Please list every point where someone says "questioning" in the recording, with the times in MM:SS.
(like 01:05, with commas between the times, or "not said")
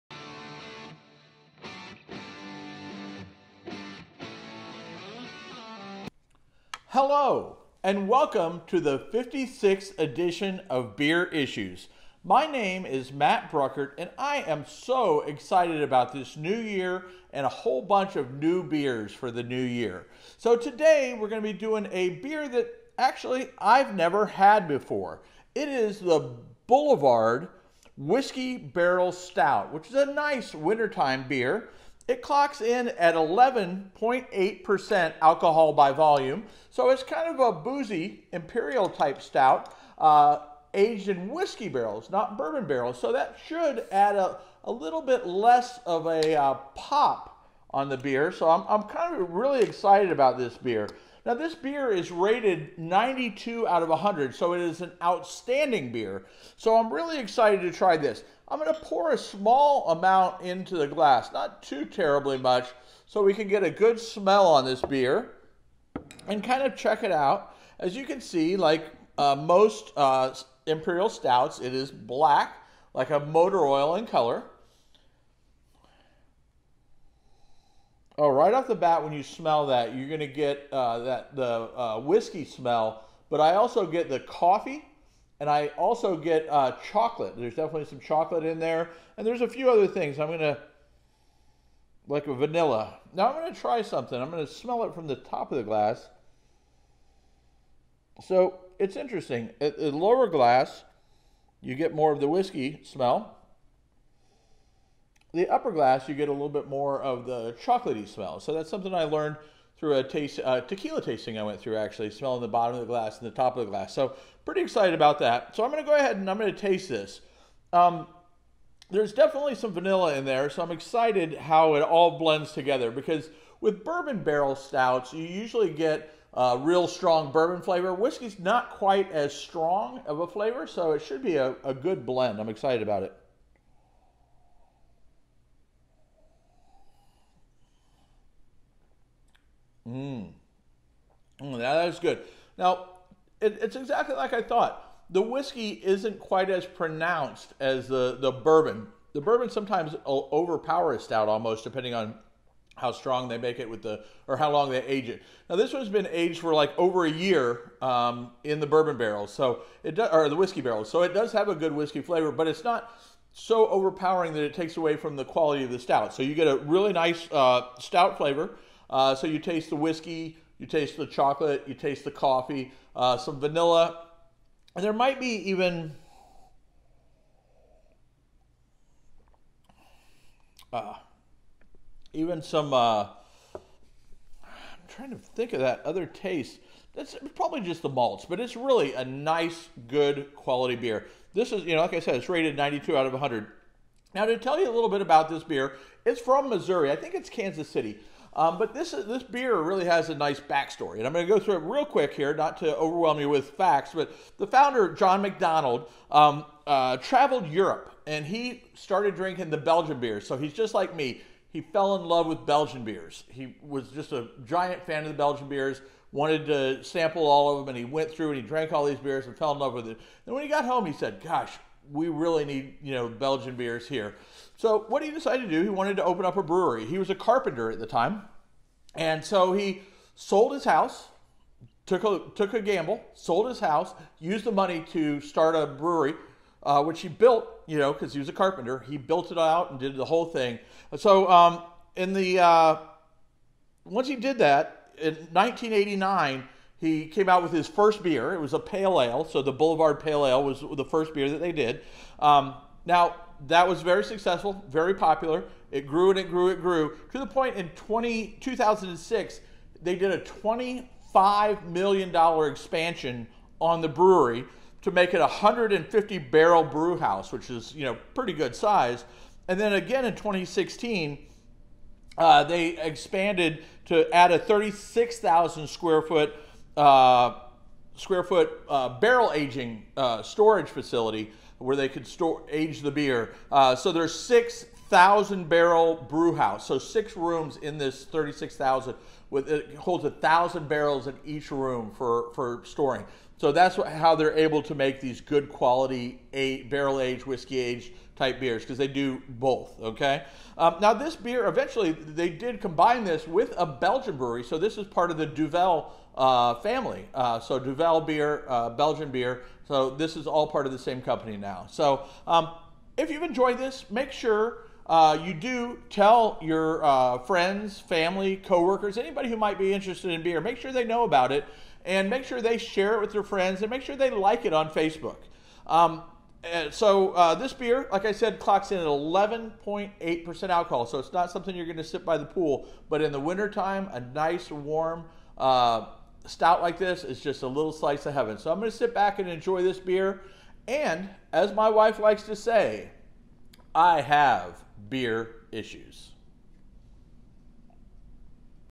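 not said.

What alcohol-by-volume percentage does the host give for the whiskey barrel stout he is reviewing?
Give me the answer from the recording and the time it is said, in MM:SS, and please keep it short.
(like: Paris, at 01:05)
11.8%, at 00:33.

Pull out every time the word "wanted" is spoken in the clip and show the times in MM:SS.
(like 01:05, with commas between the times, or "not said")
03:36, 03:45.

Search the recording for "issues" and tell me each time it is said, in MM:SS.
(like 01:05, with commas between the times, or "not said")
00:11, 05:45.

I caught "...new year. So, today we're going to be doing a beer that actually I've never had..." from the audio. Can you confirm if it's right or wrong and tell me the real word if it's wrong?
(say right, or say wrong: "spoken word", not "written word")
right.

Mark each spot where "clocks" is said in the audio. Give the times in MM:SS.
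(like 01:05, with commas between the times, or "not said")
00:32, 05:28.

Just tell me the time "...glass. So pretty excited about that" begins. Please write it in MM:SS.
01:53.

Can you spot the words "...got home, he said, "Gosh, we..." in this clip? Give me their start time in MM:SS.
03:40.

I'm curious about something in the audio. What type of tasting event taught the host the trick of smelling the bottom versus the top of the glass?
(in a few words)
Tequila tasting.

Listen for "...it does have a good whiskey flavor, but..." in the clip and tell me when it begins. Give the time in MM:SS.
02:41.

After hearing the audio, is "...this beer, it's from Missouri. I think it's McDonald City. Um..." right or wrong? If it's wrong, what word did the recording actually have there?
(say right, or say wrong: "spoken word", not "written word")
wrong: "Kansas", not "McDonald".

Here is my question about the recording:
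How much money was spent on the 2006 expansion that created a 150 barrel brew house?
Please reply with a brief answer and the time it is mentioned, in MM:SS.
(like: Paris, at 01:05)
$25 million, at 04:20.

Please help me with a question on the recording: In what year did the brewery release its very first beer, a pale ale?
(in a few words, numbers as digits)
1989.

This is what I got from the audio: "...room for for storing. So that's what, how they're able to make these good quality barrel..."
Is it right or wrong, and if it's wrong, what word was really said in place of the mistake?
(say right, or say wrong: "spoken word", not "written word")
right.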